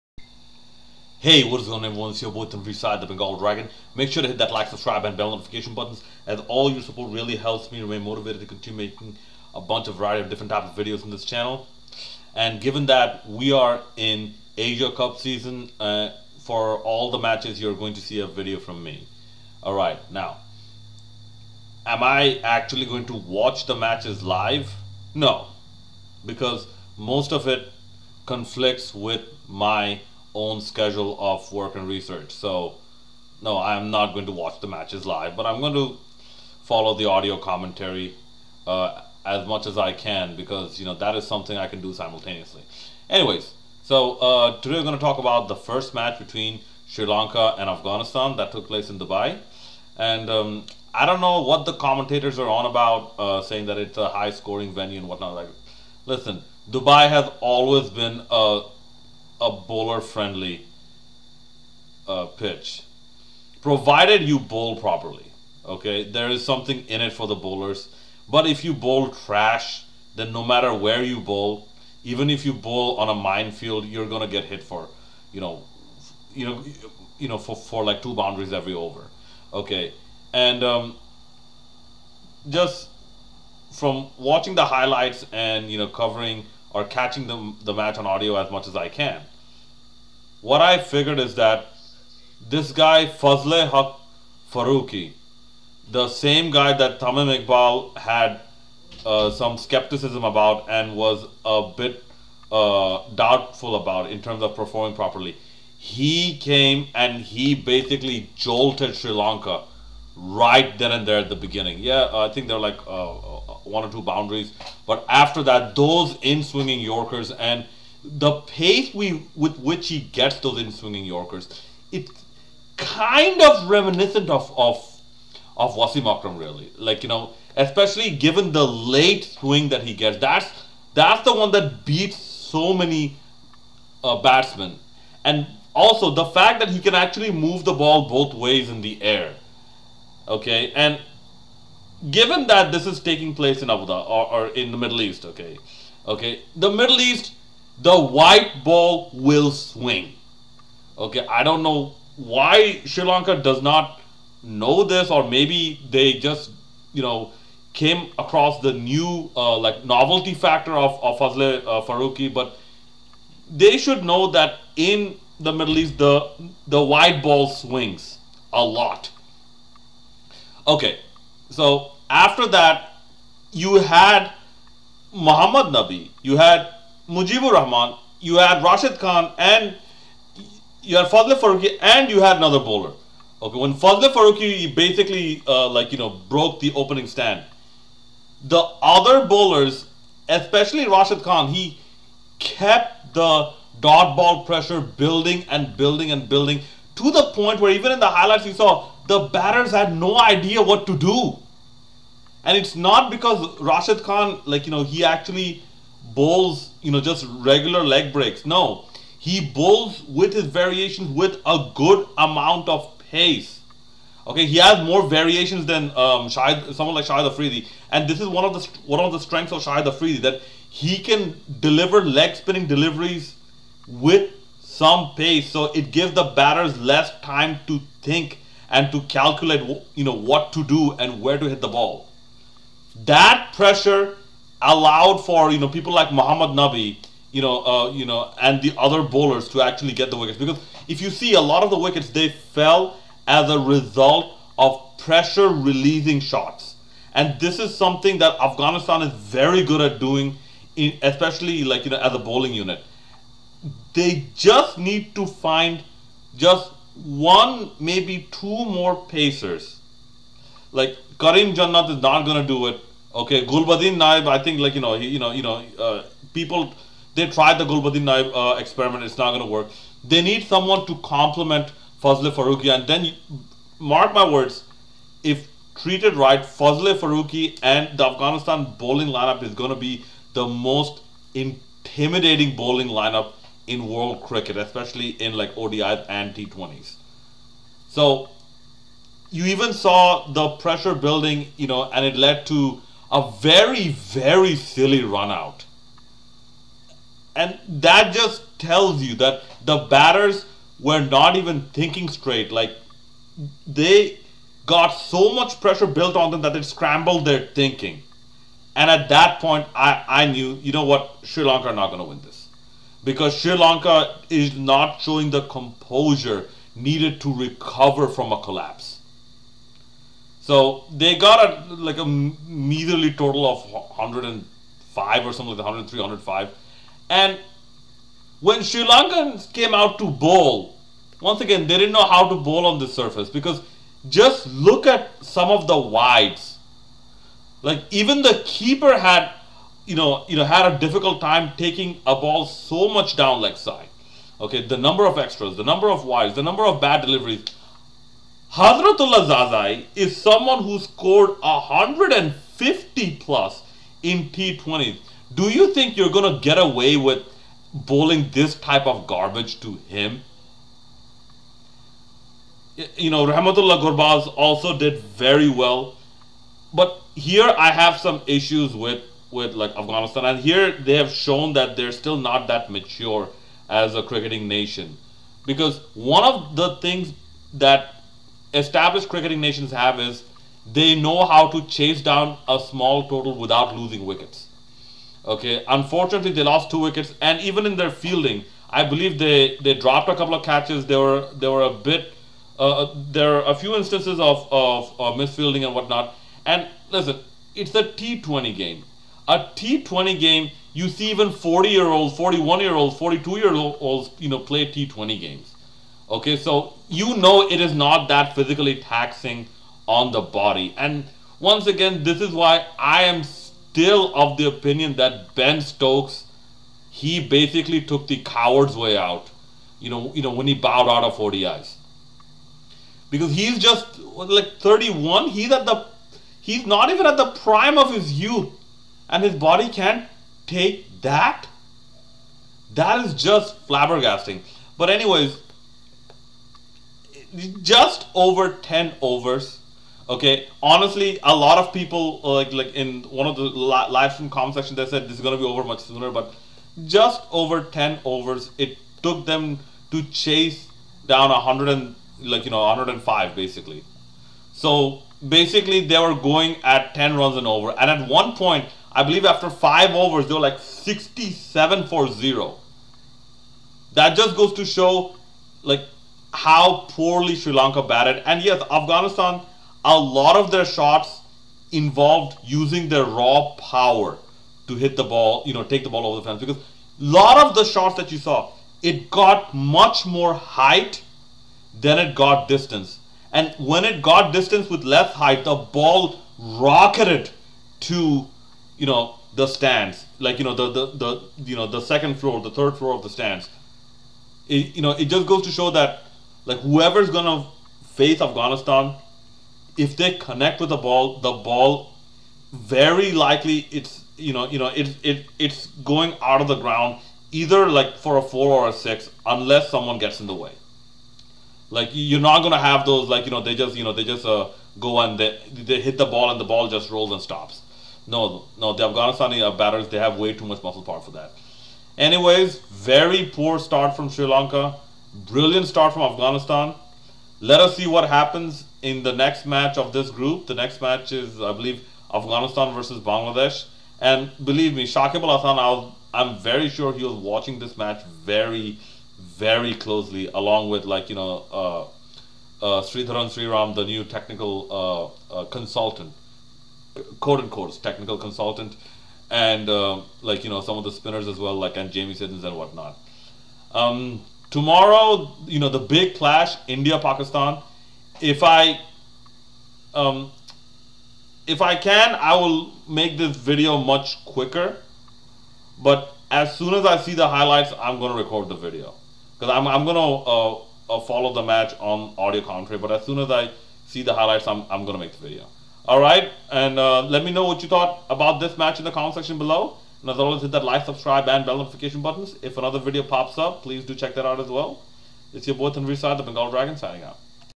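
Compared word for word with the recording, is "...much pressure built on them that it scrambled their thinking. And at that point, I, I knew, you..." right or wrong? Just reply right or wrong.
right.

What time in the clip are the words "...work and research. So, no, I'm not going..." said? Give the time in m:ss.
0:31.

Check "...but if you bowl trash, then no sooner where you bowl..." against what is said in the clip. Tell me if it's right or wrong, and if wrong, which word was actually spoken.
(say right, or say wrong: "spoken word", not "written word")
wrong: "matter", not "sooner".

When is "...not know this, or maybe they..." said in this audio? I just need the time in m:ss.
2:33.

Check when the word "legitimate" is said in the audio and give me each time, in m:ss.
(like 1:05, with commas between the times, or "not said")
not said.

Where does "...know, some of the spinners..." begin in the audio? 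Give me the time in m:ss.
9:10.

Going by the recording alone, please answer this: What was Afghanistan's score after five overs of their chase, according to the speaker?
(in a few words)
67 for 0.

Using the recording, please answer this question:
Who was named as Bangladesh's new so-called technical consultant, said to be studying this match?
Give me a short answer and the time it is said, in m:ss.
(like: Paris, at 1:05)
Sridharan Sriram, at 9:02.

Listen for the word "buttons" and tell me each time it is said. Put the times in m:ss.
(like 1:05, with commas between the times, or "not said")
0:05, 9:42.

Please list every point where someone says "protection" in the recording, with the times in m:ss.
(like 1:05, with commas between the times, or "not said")
not said.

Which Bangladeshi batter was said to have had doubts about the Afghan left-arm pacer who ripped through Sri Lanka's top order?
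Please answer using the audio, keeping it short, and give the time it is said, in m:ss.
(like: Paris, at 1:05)
Tamim Iqbal, at 1:36.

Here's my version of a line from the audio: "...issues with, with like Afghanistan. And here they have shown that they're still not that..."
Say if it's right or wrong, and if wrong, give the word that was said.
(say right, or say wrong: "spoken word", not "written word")
right.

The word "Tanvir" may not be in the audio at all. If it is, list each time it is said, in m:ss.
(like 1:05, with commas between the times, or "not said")
0:02, 9:45.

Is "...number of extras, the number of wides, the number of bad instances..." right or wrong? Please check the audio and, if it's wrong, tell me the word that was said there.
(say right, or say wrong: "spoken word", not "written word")
wrong: "deliveries", not "instances".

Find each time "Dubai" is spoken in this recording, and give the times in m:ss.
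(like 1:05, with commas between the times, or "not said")
0:48, 0:56.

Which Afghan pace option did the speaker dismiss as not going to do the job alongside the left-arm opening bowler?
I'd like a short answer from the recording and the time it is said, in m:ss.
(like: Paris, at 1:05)
Karim Jannat, at 4:21.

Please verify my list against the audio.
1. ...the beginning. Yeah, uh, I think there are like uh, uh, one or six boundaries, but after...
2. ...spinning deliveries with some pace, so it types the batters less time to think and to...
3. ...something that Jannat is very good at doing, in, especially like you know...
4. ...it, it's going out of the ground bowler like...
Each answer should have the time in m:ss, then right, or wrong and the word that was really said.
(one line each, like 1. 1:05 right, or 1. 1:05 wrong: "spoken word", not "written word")
1. 1:51 wrong: "two", not "six"
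2. 3:42 wrong: "gives", not "types"
3. 4:07 wrong: "Afghanistan", not "Jannat"
4. 8:25 wrong: "either", not "bowler".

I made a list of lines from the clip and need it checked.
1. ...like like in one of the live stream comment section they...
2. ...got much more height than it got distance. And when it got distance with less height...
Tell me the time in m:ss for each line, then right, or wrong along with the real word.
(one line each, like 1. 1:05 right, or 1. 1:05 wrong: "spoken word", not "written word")
1. 7:22 right
2. 7:59 right.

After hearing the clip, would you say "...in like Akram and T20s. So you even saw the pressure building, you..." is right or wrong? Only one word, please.
wrong.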